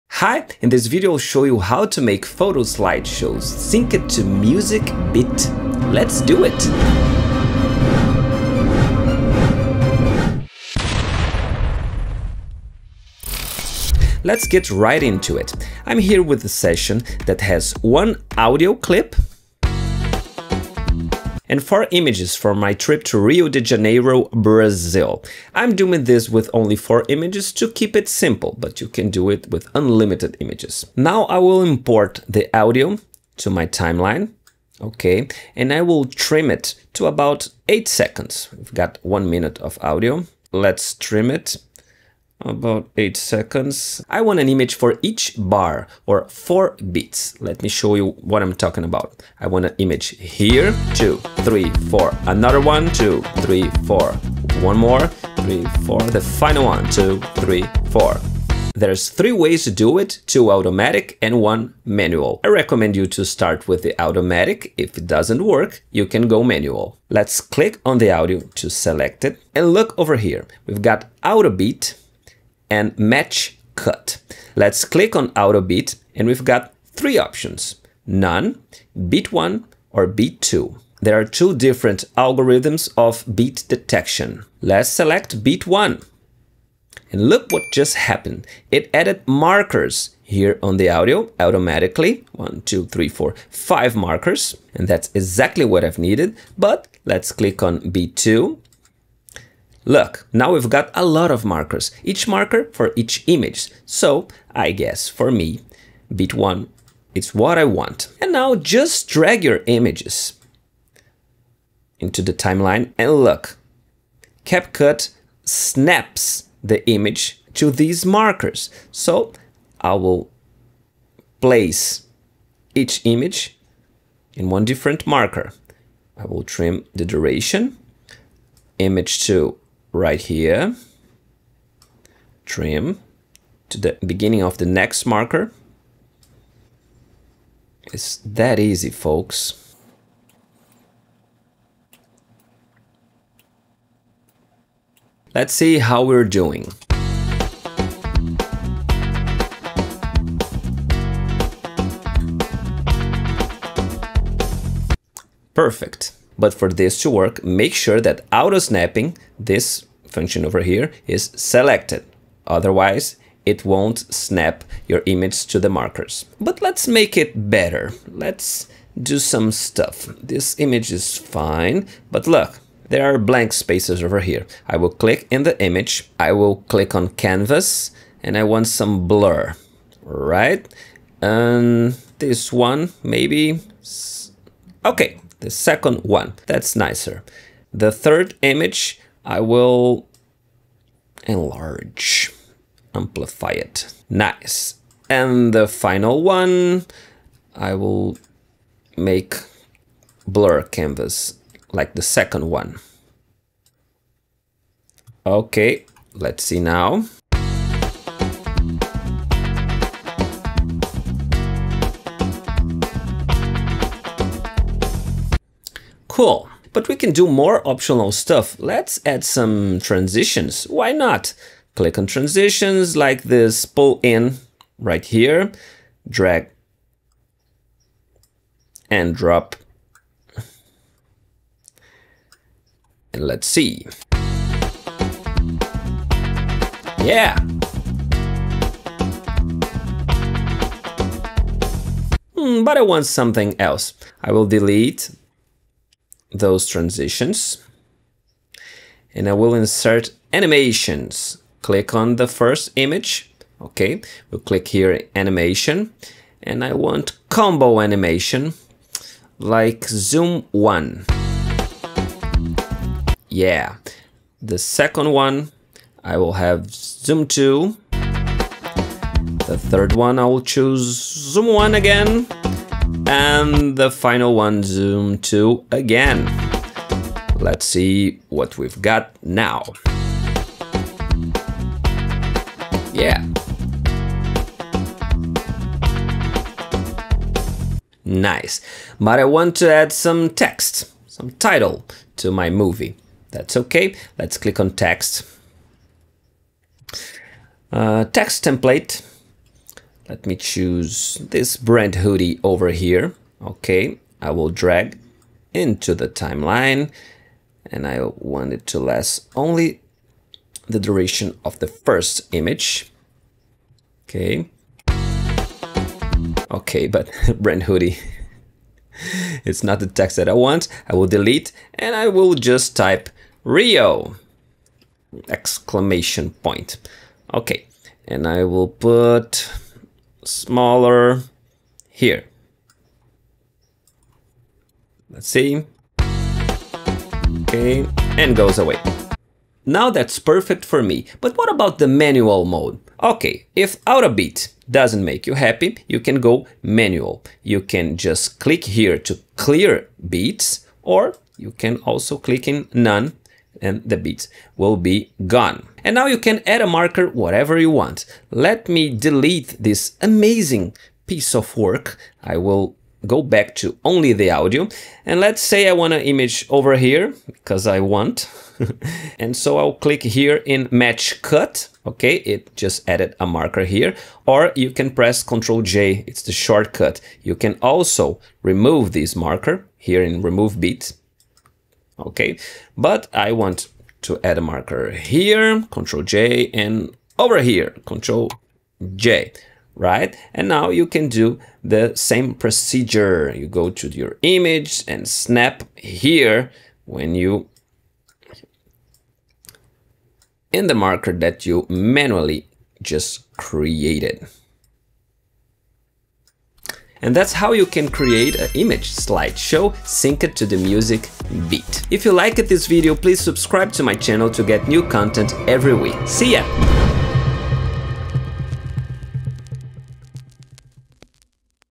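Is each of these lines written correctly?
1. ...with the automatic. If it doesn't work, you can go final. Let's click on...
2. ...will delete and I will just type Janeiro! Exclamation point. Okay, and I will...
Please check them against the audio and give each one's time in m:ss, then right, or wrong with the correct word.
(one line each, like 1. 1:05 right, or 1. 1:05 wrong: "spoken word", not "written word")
1. 1:03 wrong: "manual", not "final"
2. 5:20 wrong: "Rio", not "Janeiro".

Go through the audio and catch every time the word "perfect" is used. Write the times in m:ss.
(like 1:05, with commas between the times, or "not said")
2:35, 5:40.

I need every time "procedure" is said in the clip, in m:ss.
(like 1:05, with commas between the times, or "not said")
6:32.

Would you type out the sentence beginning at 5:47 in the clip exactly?
You can just click here to clear beats, or you can also click in none and the bits will be gone.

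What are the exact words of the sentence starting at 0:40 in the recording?
Let's trim it about 8 seconds.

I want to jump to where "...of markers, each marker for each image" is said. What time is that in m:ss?
1:41.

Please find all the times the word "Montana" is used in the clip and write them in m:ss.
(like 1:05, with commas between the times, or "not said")
not said.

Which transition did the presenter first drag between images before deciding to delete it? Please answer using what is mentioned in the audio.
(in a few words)
Pull in.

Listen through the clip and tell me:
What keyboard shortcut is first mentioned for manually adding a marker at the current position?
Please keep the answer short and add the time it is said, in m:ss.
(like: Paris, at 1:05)
Ctrl J, at 6:15.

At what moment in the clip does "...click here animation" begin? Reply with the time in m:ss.
4:14.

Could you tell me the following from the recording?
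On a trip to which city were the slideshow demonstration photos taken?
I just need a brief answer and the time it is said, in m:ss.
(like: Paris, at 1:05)
Rio de Janeiro, at 0:23.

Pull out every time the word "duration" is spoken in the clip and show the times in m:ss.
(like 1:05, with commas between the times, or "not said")
2:07, 5:10.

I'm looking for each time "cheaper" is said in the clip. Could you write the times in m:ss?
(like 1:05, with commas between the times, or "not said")
not said.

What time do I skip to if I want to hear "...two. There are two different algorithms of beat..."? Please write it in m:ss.
1:20.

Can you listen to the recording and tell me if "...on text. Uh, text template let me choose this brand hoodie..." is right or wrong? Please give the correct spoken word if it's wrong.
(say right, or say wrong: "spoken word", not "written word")
right.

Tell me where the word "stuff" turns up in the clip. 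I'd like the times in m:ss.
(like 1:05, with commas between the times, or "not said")
2:49, 3:38.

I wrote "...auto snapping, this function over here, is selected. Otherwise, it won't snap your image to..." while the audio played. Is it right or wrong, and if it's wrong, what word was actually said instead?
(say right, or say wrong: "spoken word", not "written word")
right.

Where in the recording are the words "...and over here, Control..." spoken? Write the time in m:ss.
6:26.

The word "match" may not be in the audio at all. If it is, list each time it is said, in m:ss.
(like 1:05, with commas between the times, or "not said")
1:12, 6:10.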